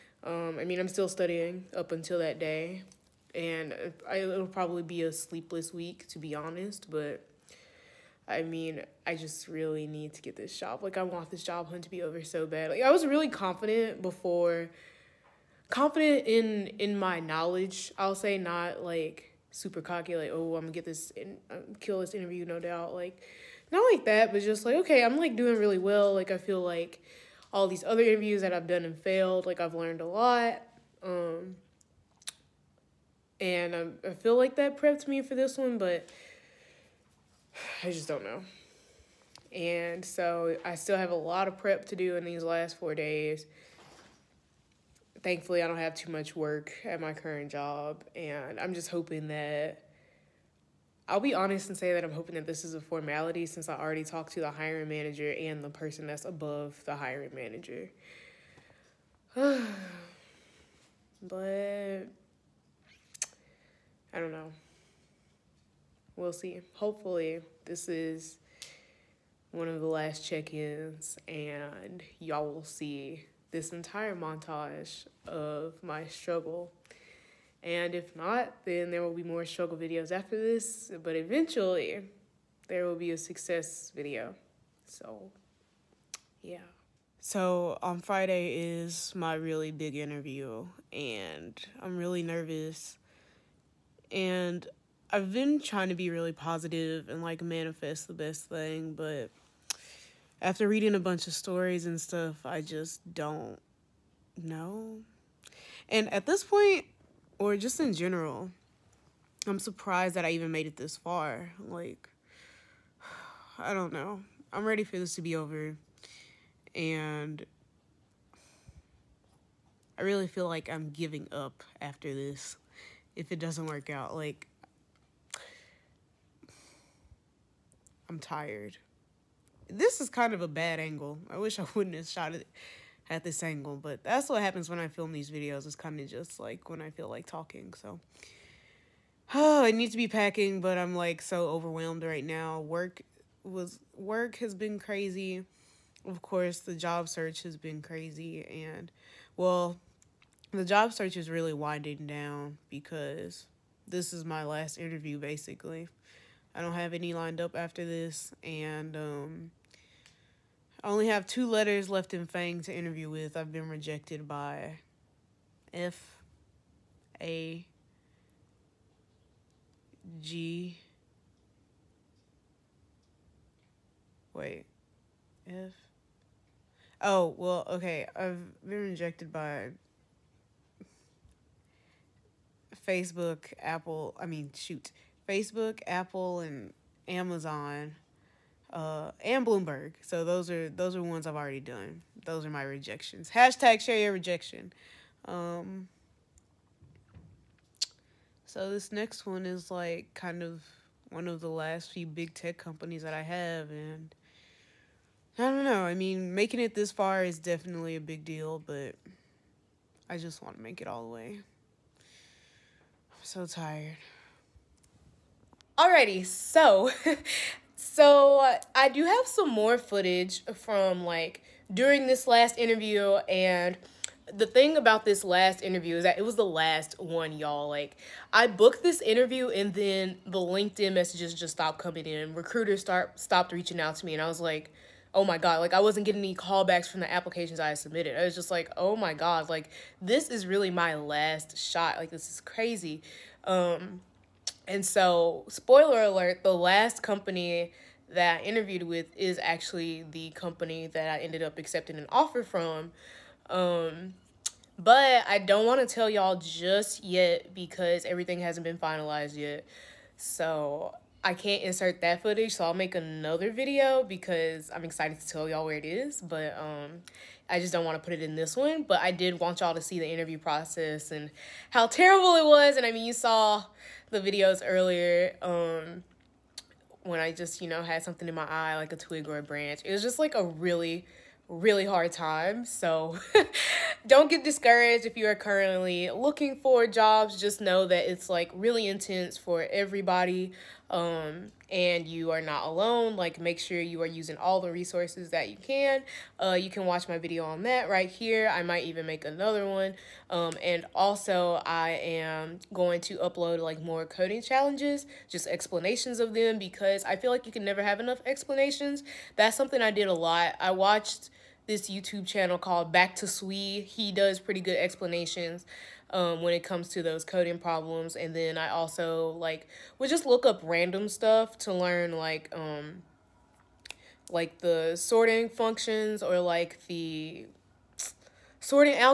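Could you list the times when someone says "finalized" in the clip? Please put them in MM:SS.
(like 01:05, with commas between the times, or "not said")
04:18.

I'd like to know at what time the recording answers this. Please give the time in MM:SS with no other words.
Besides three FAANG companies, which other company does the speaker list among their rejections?
03:09.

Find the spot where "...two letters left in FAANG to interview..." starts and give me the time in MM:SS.
02:41.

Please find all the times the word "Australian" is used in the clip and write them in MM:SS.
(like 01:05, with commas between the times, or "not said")
not said.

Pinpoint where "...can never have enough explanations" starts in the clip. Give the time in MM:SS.
05:07.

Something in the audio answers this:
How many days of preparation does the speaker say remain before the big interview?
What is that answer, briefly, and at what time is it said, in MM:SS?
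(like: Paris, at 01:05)
4, at 00:42.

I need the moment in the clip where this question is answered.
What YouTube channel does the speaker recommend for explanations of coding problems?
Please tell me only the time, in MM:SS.
05:12.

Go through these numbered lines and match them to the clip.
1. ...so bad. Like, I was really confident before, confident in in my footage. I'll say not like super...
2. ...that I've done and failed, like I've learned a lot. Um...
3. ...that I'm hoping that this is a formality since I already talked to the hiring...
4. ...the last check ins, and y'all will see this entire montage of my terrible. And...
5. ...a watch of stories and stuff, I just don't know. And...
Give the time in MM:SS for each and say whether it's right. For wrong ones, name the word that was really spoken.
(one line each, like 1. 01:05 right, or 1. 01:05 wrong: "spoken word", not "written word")
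1. 00:12 wrong: "knowledge", not "footage"
2. 00:28 right
3. 00:51 right
4. 01:09 wrong: "struggle", not "terrible"
5. 01:40 wrong: "bunch", not "watch".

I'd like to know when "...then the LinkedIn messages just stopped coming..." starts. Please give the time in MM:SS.
03:49.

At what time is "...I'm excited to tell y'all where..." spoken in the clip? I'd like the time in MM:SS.
04:24.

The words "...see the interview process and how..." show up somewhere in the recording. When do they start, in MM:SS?
04:29.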